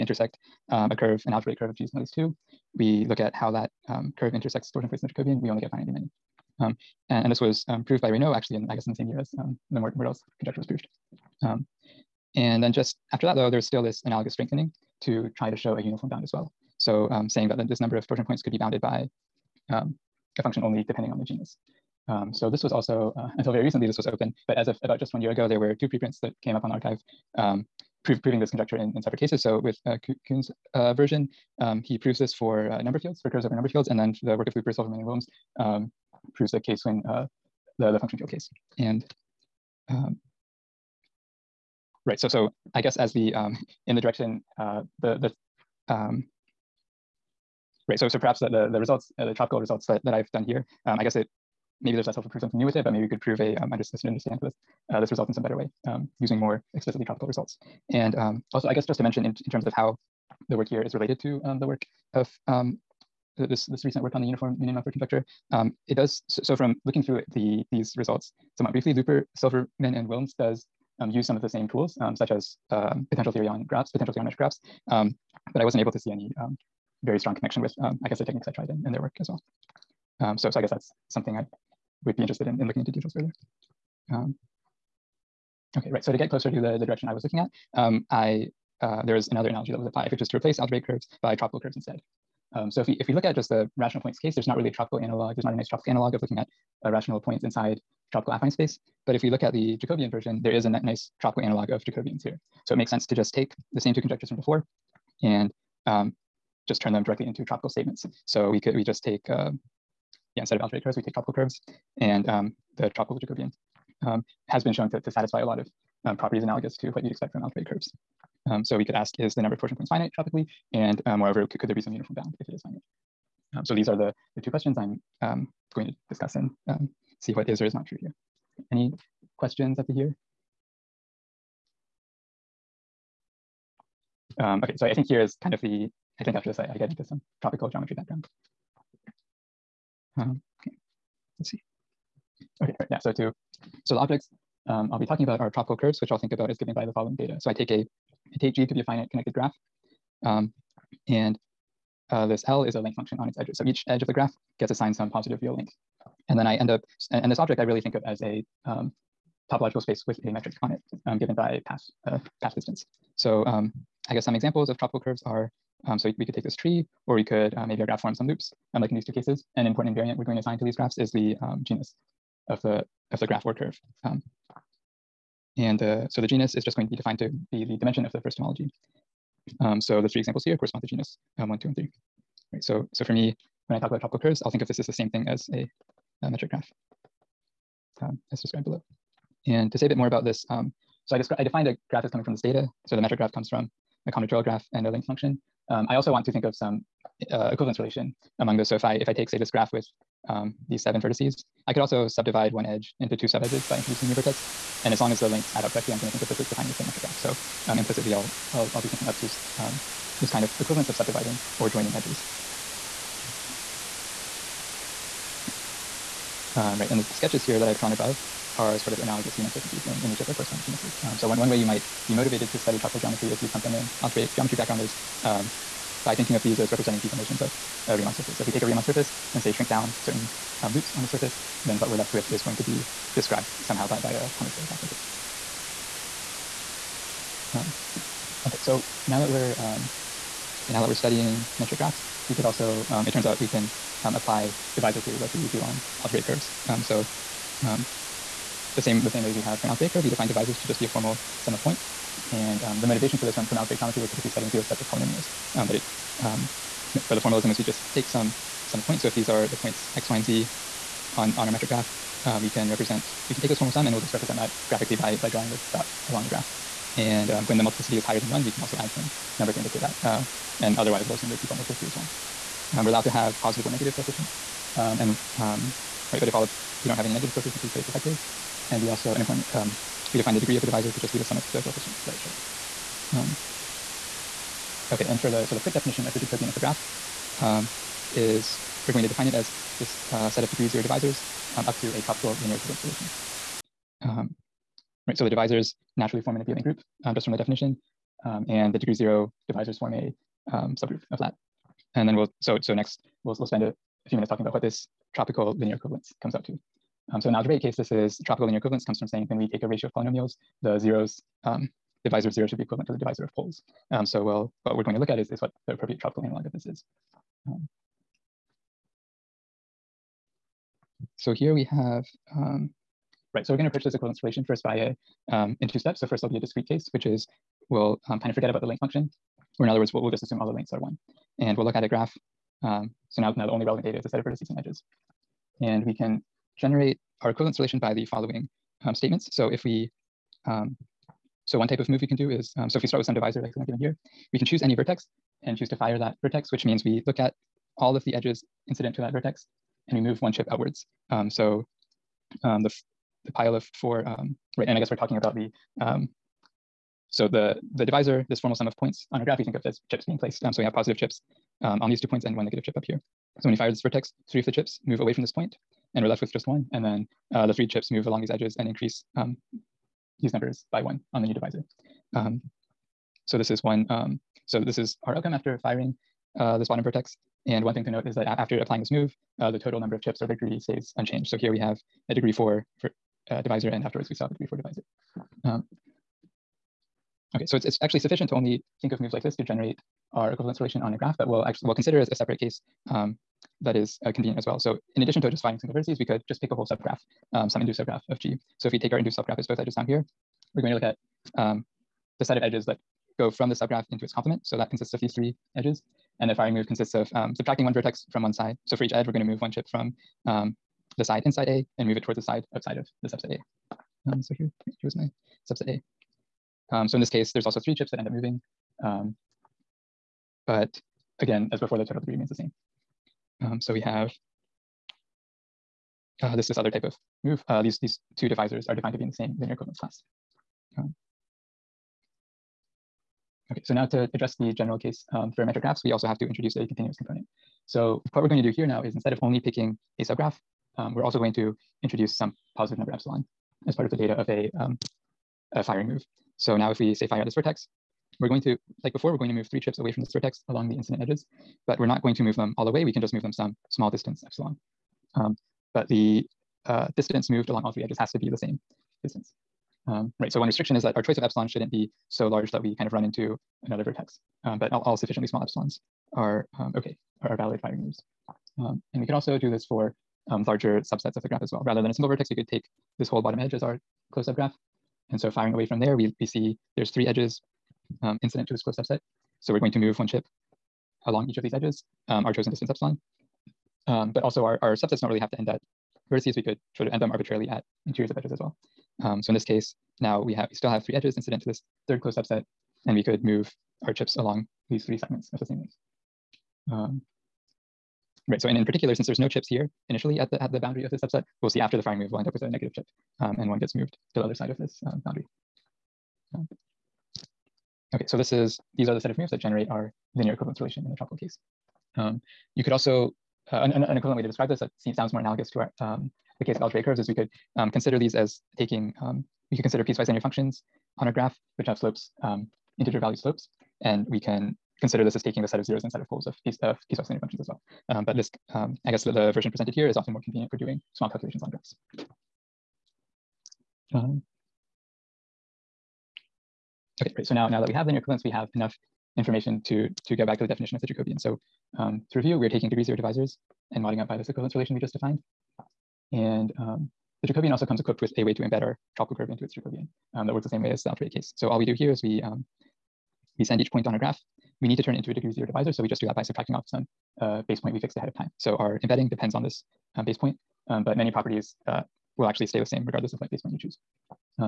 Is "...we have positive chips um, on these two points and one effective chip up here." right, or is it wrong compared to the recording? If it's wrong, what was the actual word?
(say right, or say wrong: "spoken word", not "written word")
wrong: "negative", not "effective".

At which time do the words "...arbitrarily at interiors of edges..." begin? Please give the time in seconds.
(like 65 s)
487 s.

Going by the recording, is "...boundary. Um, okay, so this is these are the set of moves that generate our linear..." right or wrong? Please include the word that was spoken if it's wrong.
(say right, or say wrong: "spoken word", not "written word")
right.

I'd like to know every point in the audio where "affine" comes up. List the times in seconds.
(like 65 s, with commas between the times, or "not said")
98 s.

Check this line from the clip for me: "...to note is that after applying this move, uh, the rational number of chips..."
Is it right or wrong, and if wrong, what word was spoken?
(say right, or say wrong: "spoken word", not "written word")
wrong: "total", not "rational".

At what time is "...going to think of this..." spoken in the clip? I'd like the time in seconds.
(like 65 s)
205 s.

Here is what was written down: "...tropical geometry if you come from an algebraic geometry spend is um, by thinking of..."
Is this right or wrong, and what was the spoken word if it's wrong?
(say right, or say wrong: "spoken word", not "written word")
wrong: "background", not "spend".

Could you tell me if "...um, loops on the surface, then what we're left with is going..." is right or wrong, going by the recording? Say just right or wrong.
right.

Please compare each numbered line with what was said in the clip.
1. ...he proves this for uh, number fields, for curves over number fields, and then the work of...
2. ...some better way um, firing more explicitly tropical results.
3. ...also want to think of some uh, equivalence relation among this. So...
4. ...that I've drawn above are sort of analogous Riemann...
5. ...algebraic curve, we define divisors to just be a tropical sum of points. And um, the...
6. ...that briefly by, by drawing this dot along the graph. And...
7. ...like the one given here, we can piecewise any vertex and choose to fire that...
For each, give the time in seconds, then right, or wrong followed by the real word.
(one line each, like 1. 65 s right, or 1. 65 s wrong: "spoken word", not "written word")
1. 31 s right
2. 55 s wrong: "using", not "firing"
3. 195 s right
4. 217 s right
5. 249 s wrong: "formal", not "tropical"
6. 264 s wrong: "graphically", not "briefly"
7. 343 s wrong: "choose", not "piecewise".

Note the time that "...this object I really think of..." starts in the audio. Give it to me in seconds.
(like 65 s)
157 s.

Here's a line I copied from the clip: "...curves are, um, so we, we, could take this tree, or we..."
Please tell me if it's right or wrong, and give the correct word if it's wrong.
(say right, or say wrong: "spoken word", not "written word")
right.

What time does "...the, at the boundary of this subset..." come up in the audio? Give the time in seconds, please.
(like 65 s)
500 s.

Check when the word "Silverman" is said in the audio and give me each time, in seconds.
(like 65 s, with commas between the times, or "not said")
34 s, 69 s.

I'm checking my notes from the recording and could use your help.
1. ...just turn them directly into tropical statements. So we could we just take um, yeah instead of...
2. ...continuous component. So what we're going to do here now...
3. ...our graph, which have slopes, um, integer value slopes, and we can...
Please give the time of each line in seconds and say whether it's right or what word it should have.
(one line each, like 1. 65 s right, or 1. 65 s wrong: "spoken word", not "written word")
1. 106 s right
2. 436 s right
3. 521 s right.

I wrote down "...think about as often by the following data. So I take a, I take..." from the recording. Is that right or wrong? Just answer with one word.
wrong.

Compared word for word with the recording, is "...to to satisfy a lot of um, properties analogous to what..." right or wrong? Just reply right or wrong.
right.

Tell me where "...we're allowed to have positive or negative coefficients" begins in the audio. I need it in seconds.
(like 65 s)
272 s.